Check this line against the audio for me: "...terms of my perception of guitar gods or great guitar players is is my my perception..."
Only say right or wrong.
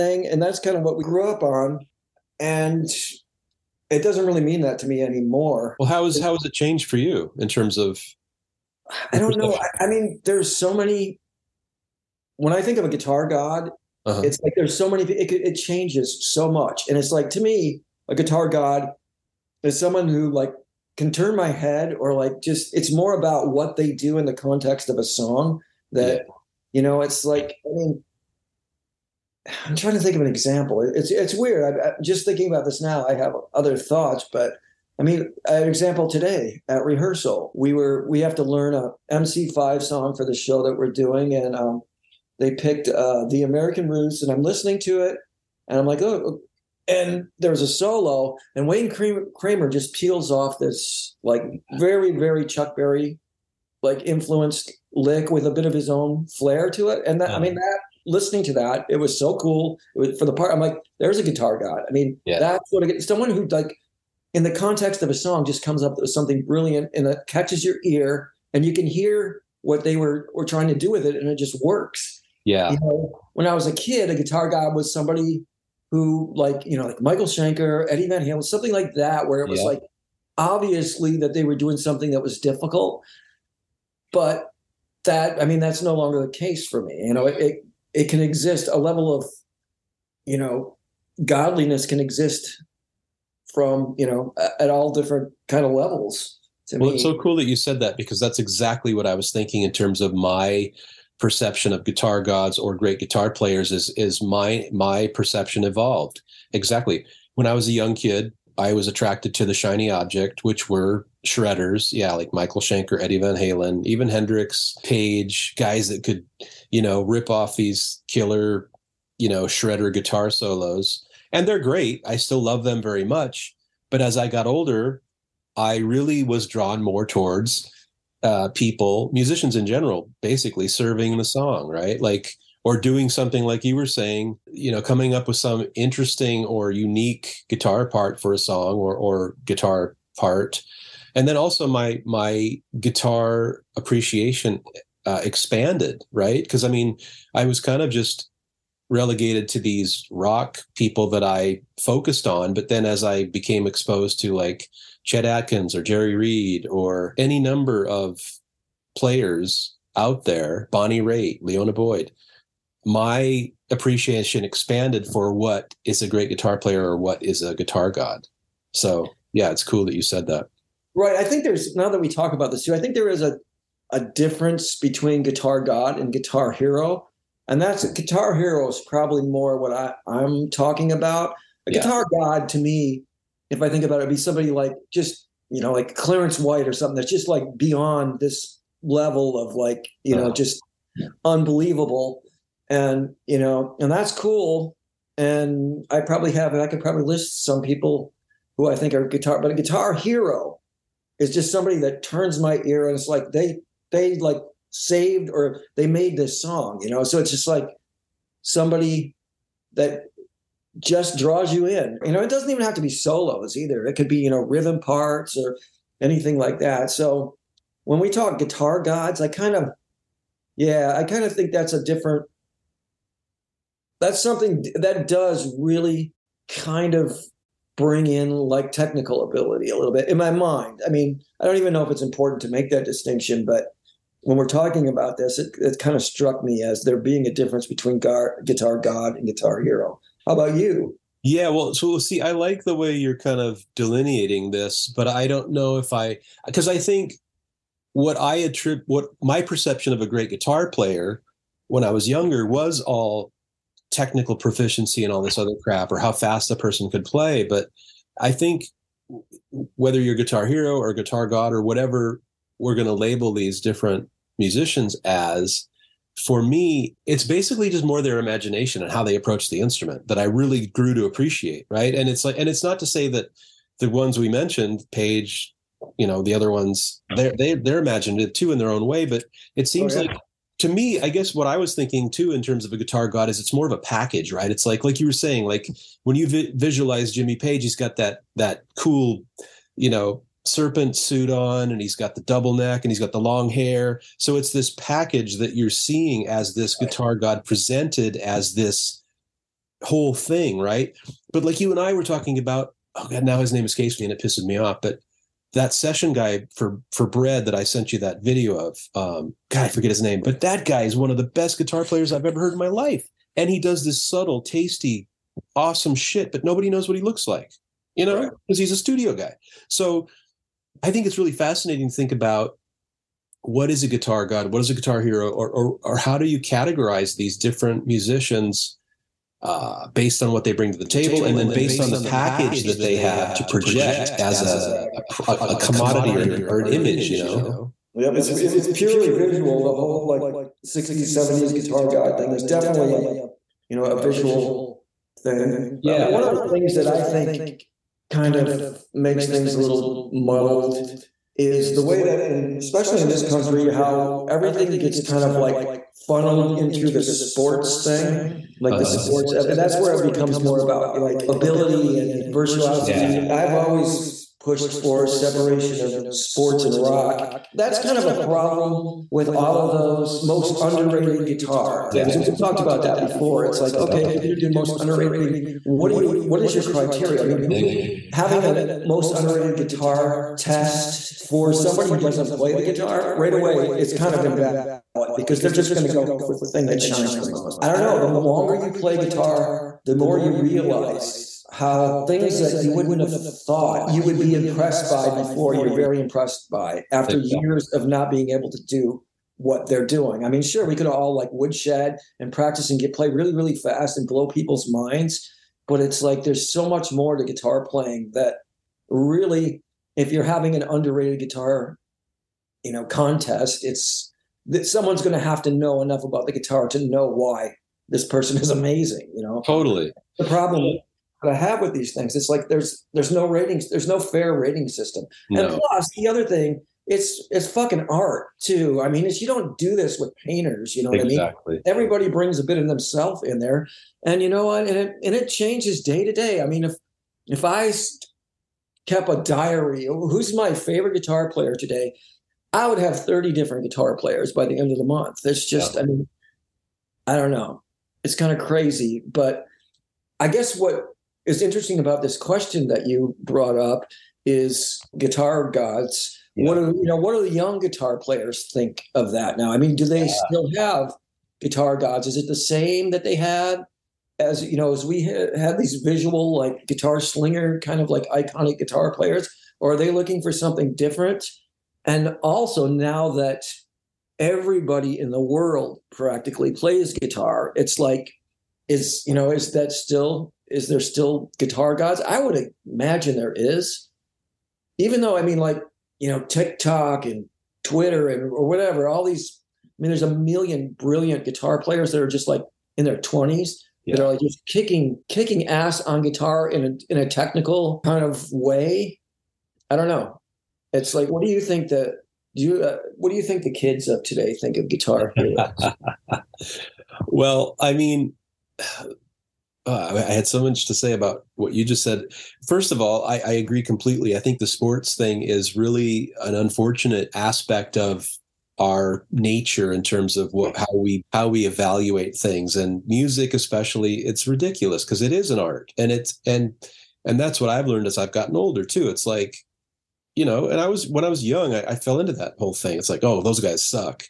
right.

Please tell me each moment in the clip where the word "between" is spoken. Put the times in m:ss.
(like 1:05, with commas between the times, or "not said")
2:54, 3:57.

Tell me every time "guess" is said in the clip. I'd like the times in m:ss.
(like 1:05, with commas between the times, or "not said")
4:41, 7:30.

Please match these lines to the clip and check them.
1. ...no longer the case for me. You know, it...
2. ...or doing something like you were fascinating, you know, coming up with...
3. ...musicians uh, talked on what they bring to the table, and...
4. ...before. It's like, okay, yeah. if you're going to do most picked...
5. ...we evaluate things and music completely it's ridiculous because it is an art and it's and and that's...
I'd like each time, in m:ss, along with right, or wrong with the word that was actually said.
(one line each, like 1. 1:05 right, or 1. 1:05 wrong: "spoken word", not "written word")
1. 1:25 right
2. 2:12 wrong: "saying", not "fascinating"
3. 5:27 wrong: "based", not "talked"
4. 6:12 wrong: "underrated", not "picked"
5. 8:41 wrong: "especially", not "completely".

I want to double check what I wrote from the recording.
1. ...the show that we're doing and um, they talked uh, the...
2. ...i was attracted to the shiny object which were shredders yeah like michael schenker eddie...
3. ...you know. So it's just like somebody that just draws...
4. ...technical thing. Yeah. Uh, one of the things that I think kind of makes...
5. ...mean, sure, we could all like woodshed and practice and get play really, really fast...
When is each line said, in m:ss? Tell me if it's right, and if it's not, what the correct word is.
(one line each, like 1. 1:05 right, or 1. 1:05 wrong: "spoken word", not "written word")
1. 0:40 wrong: "picked", not "talked"
2. 1:48 right
3. 3:26 right
4. 5:43 wrong: "visual", not "technical"
5. 6:40 right.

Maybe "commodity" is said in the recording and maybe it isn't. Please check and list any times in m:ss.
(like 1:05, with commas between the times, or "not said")
5:35.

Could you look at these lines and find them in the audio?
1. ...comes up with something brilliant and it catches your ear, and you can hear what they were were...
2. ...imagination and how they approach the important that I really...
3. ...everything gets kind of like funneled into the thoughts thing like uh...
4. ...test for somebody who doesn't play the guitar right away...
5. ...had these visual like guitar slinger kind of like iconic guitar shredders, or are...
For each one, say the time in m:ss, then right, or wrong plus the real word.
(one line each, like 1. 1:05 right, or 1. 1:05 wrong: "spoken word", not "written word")
1. 1:05 right
2. 4:28 wrong: "instrument", not "important"
3. 5:54 wrong: "sports", not "thoughts"
4. 6:20 right
5. 7:45 wrong: "players", not "shredders".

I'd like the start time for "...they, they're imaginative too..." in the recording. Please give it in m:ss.
4:37.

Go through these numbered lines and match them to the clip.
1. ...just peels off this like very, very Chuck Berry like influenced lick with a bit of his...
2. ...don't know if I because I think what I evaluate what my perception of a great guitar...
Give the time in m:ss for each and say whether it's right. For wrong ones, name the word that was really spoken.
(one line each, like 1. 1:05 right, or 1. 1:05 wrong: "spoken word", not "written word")
1. 0:49 right
2. 4:05 wrong: "attribute", not "evaluate".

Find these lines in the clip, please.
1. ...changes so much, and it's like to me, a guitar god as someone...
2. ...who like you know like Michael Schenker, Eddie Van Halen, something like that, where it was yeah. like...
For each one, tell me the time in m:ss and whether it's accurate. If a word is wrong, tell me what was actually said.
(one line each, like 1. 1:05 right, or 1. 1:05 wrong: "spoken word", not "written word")
1. 0:15 right
2. 1:15 right.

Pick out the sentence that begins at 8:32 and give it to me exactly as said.
First of all, I, I, agree completely.